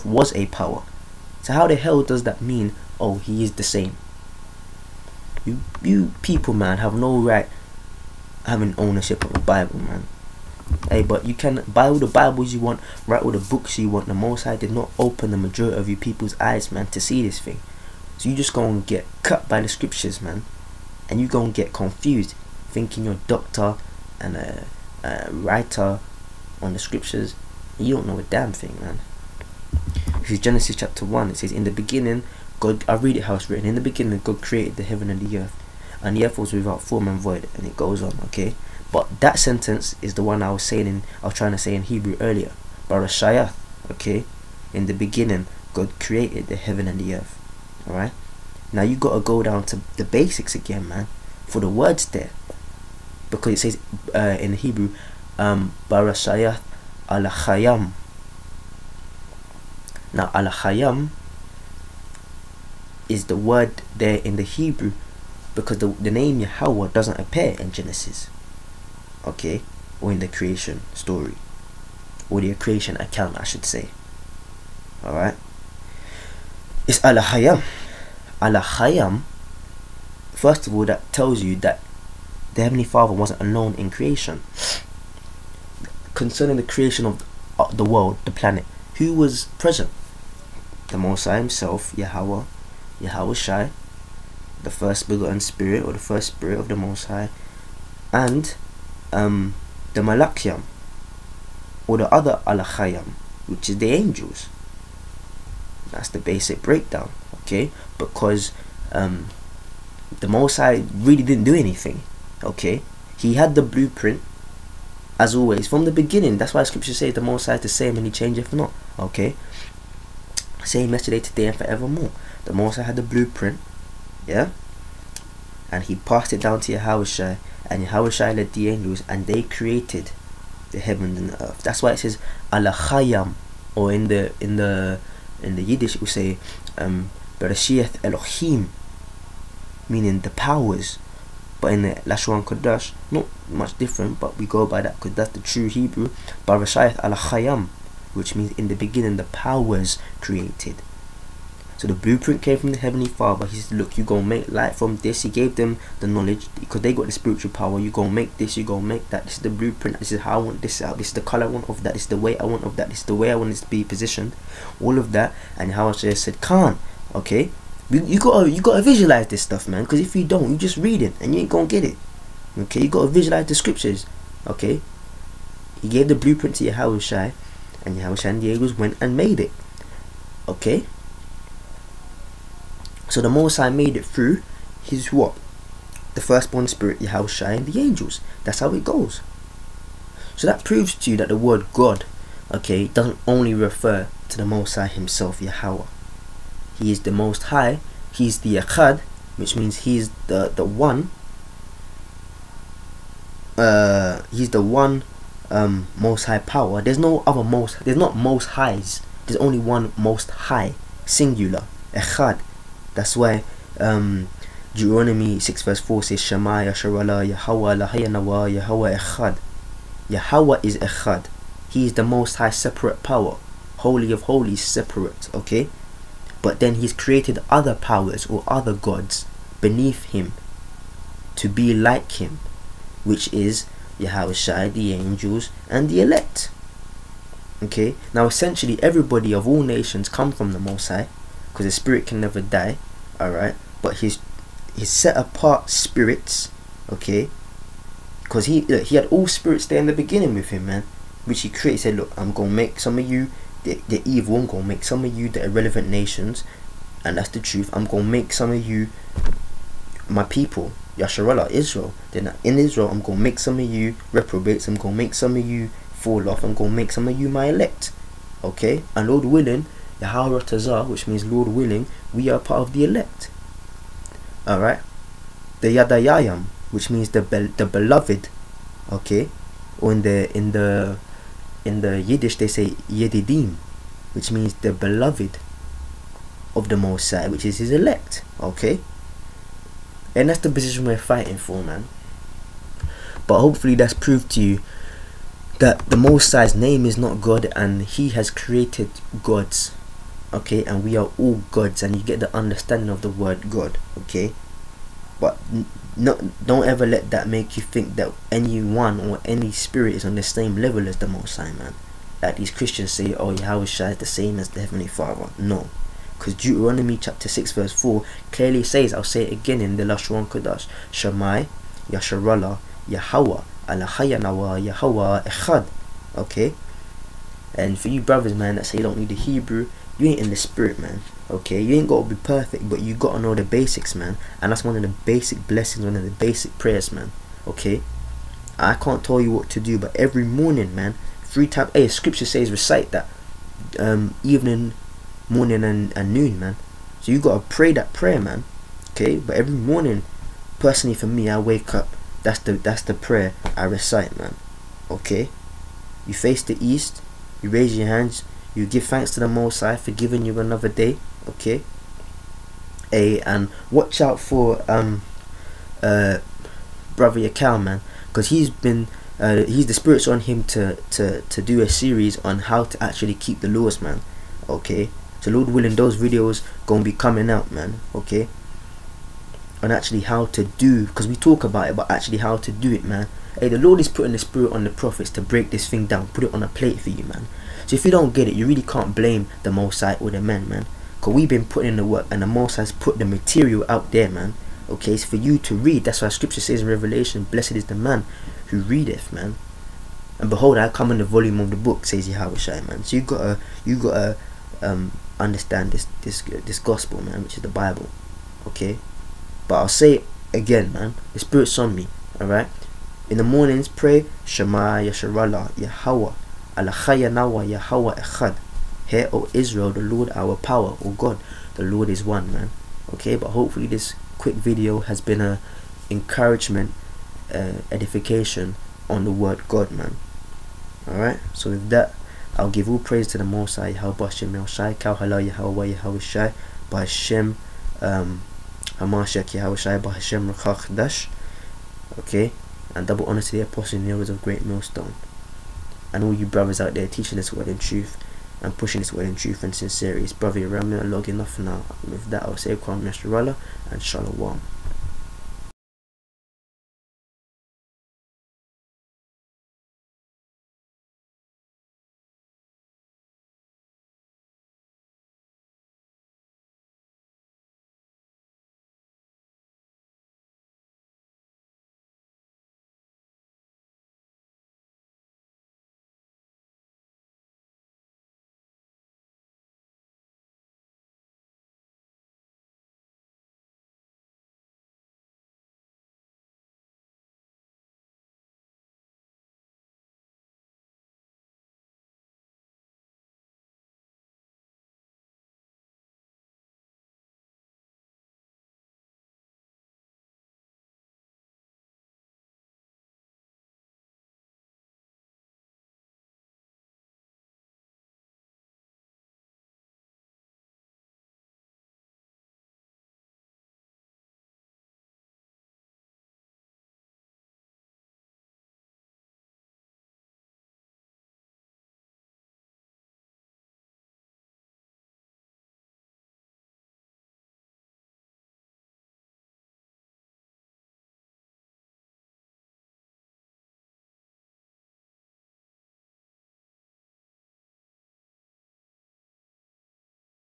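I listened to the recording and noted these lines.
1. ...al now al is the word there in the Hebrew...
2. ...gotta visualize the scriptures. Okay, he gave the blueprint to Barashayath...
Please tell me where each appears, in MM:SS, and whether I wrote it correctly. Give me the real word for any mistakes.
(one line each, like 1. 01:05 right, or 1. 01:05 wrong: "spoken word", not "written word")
1. 00:57 right
2. 02:52 wrong: "Yahushua", not "Barashayath".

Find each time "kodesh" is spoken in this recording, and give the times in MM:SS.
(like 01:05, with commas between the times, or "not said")
02:22, 05:20.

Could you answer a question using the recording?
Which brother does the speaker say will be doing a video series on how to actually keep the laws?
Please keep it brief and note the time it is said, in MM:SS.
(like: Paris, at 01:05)
Yakal, at 06:06.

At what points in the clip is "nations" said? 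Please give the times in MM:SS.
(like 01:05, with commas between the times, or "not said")
03:59, 04:15.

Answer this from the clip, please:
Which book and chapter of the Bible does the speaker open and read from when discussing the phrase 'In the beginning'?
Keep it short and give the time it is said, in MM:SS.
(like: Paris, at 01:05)
Genesis chapter one, at 00:30.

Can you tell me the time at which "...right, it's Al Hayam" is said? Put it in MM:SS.
01:15.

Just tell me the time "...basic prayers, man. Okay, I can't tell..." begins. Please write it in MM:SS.
05:36.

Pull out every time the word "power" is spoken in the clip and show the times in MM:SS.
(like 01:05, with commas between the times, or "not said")
00:00, 02:20, 02:29, 02:37, 03:26, 03:43, 03:47, 07:00.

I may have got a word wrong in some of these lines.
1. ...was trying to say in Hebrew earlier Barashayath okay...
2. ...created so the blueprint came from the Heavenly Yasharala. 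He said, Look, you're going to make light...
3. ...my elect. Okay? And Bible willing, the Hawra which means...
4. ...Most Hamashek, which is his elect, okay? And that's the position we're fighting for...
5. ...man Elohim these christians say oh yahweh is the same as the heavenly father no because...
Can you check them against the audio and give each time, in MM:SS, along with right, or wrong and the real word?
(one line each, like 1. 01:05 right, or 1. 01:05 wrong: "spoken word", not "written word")
1. 00:41 right
2. 02:30 wrong: "Father", not "Yasharala"
3. 04:27 wrong: "Lord", not "Bible"
4. 04:46 wrong: "High", not "Hamashek"
5. 05:11 wrong: "That", not "Elohim".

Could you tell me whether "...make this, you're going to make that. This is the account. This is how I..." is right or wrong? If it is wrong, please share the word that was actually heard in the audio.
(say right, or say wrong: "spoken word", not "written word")
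wrong: "blueprint", not "account".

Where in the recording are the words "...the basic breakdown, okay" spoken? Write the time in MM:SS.
01:46.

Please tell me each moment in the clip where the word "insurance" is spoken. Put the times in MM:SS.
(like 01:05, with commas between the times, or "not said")
not said.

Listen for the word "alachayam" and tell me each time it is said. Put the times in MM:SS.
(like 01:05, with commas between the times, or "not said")
01:42, 02:12, 02:26.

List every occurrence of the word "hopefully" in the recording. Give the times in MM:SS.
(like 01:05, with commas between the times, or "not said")
04:53, 07:03.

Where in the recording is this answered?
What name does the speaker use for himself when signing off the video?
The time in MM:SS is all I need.
07:30.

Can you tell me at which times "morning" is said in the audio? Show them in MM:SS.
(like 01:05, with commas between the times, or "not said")
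05:40, 05:45, 05:49, 06:53.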